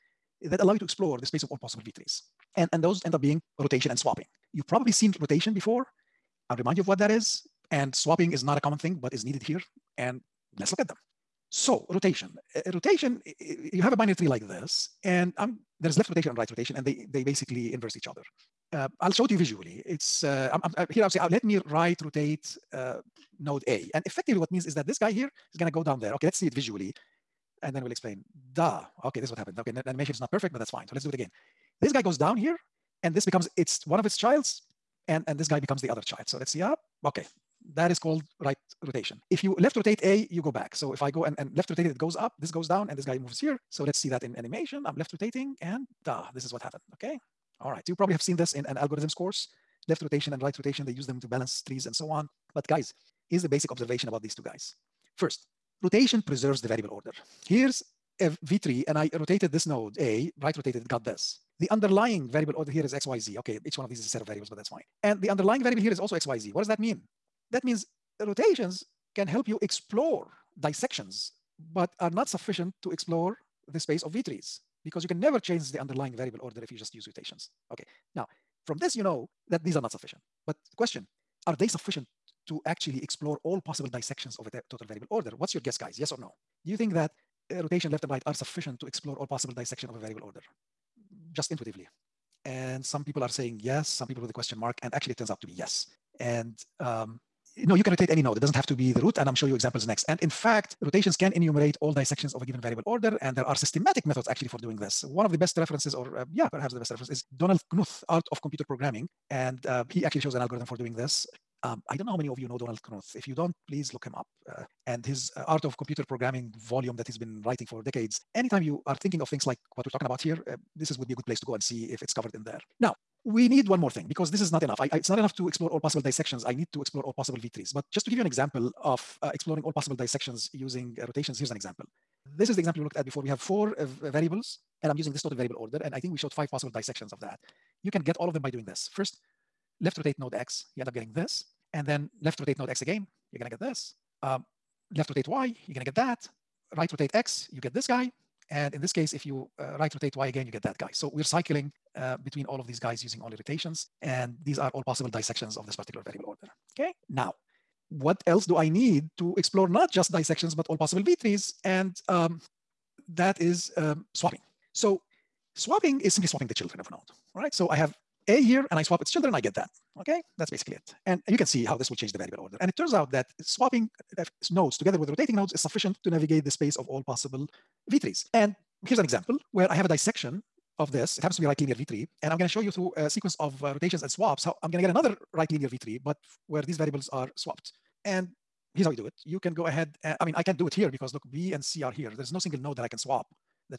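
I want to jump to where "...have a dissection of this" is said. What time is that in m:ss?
2:59.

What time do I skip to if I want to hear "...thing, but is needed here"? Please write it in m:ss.
0:08.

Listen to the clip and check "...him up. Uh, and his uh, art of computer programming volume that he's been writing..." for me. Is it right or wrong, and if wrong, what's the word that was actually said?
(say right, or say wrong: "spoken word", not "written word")
right.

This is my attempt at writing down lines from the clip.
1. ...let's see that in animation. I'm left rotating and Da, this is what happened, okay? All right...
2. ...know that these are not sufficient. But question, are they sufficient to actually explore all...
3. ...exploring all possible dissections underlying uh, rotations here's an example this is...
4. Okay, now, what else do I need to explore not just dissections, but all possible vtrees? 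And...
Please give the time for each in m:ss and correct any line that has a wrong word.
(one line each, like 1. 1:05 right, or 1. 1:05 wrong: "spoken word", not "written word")
1. 0:43 right
2. 1:19 right
3. 2:09 wrong: "using", not "underlying"
4. 2:36 right.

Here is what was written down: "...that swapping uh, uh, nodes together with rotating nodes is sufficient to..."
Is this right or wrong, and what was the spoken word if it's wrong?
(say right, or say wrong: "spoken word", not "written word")
right.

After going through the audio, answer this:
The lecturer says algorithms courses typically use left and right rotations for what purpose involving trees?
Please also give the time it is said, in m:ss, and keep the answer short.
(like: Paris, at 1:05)
To balance trees, at 0:51.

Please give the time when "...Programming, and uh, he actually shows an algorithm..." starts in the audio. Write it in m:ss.
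1:48.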